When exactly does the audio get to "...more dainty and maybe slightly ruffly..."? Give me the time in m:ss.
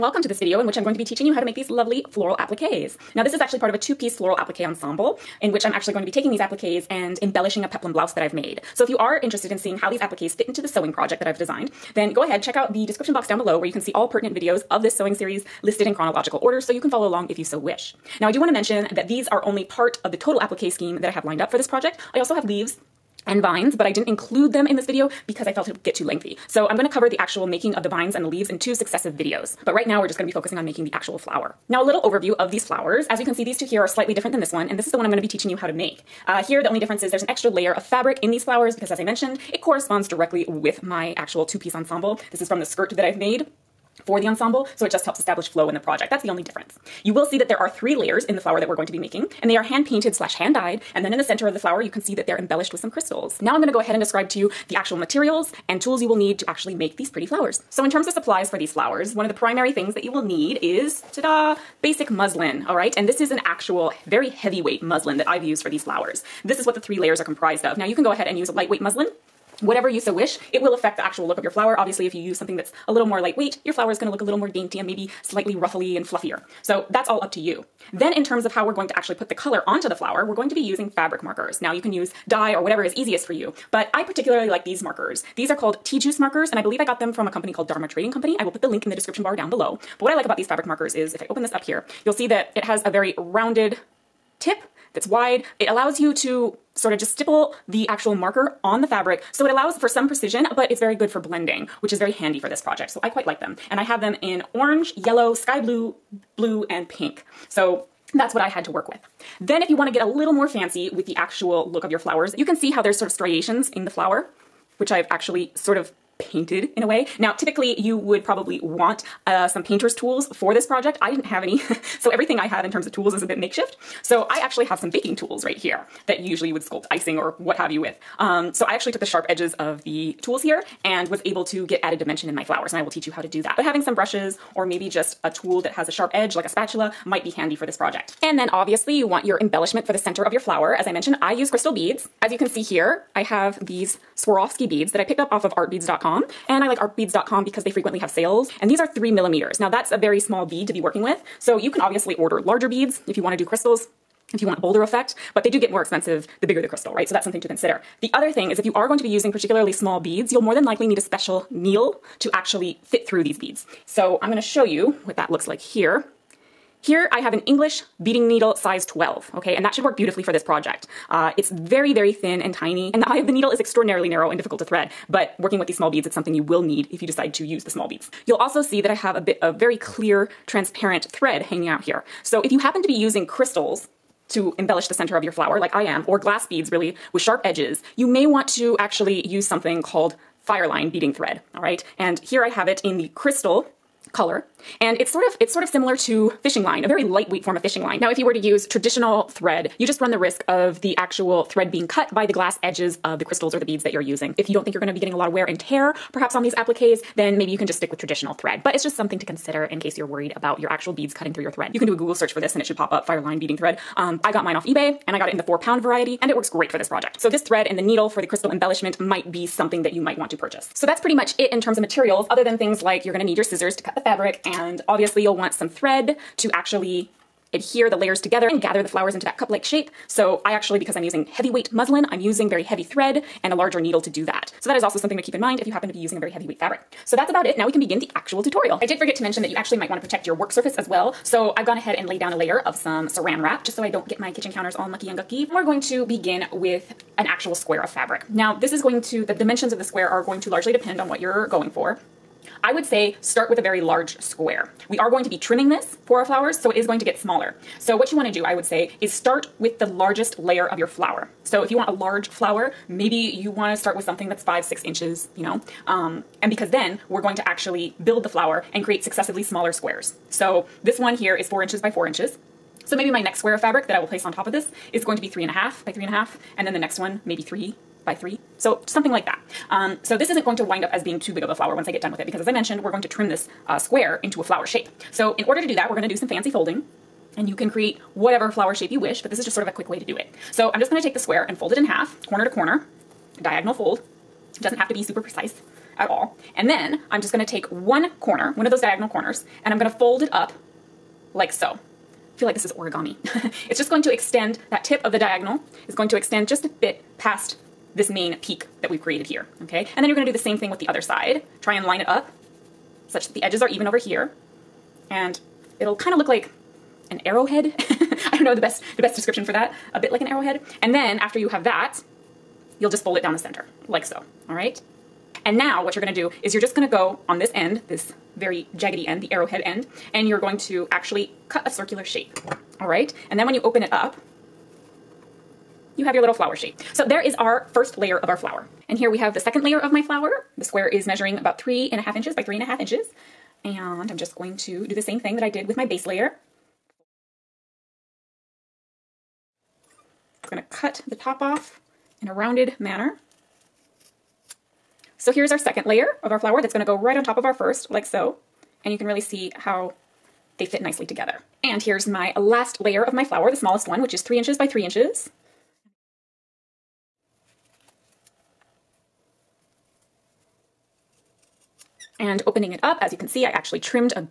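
1:14.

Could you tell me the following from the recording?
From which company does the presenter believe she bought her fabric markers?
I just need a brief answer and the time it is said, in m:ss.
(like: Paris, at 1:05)
Dharma Trading Company, at 1:27.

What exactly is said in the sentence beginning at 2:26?
And I like artbeads.com because they frequently have sales.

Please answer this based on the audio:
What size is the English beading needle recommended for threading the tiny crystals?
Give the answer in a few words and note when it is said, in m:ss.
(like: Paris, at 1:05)
12, at 2:48.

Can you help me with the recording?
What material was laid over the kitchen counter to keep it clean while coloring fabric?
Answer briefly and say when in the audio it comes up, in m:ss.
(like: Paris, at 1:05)
saran wrap, at 4:03.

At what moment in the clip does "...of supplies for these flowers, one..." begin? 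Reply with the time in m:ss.
0:58.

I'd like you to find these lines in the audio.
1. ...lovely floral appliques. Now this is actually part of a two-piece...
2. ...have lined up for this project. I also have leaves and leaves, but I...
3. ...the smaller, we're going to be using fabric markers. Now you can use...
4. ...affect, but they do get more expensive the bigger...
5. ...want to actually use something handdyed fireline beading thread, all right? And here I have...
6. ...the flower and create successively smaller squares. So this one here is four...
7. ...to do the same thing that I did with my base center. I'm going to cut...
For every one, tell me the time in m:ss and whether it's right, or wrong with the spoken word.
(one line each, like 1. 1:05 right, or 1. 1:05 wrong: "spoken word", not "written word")
1. 0:01 right
2. 0:21 wrong: "vines", not "leaves"
3. 1:19 wrong: "flower", not "smaller"
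4. 2:34 wrong: "effect", not "affect"
5. 3:08 wrong: "called", not "handdyed"
6. 4:28 right
7. 5:44 wrong: "layer", not "center".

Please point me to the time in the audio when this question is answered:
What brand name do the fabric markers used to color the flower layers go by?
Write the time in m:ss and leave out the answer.
1:25.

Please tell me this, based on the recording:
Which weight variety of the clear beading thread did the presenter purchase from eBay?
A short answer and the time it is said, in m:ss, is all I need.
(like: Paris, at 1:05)
4 pound, at 3:35.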